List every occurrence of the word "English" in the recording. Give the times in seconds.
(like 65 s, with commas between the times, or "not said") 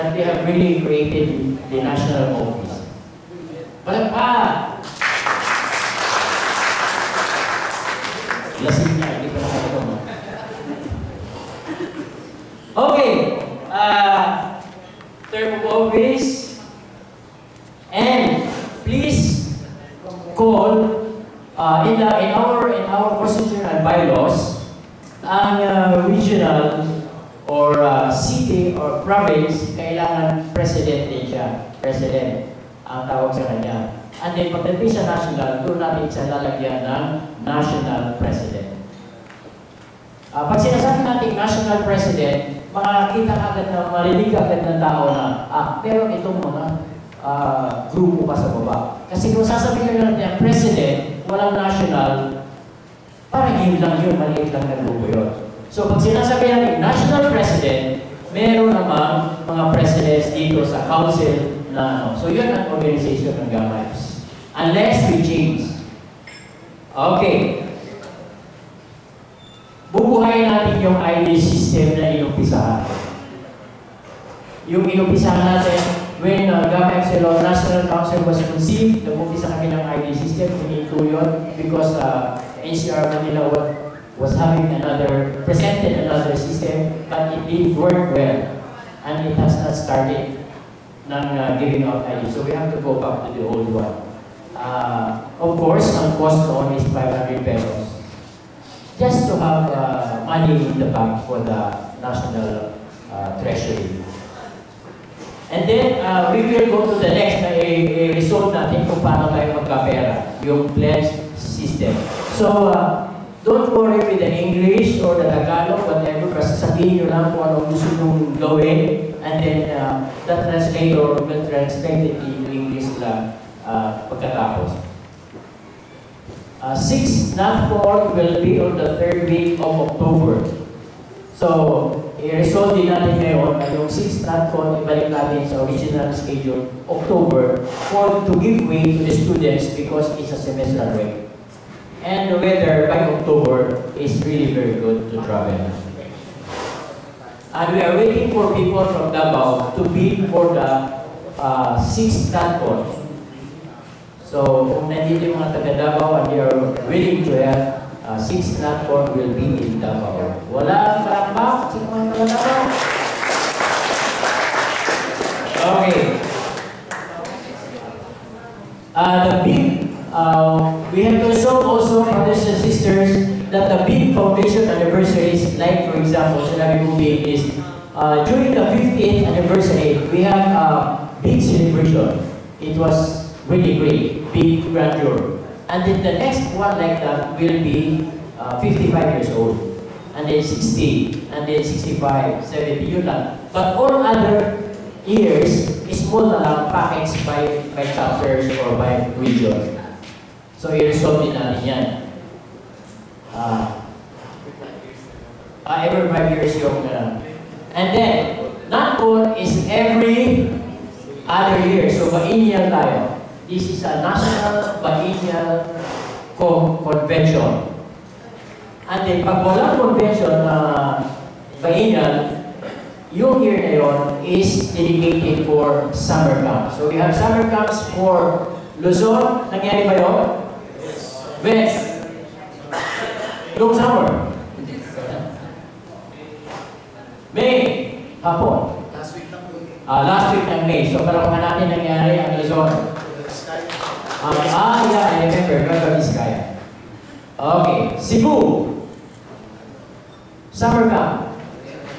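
114 s, 122 s.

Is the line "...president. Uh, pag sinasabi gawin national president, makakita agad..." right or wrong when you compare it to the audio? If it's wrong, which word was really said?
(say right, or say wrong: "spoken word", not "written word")
wrong: "natin", not "gawin".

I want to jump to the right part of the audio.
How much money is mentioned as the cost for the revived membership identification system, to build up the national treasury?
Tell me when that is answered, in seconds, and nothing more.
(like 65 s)
96 s.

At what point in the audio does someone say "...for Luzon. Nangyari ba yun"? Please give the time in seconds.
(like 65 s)
227 s.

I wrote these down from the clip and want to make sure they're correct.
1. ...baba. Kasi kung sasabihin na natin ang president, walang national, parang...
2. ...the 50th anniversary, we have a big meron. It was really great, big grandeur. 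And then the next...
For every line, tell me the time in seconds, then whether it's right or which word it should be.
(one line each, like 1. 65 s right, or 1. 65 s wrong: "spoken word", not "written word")
1. 48 s right
2. 178 s wrong: "celebration", not "meron".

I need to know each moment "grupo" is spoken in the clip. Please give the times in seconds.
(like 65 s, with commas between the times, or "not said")
47 s, 54 s.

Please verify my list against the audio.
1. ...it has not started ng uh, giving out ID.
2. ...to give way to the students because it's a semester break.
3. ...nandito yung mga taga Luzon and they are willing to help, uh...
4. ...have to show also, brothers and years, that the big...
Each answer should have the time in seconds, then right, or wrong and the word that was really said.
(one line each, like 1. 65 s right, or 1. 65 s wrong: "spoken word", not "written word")
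1. 89 s right
2. 138 s right
3. 154 s wrong: "Davao", not "Luzon"
4. 171 s wrong: "sisters", not "years".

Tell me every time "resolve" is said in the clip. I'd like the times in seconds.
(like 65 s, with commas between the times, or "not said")
107 s, 132 s, 200 s.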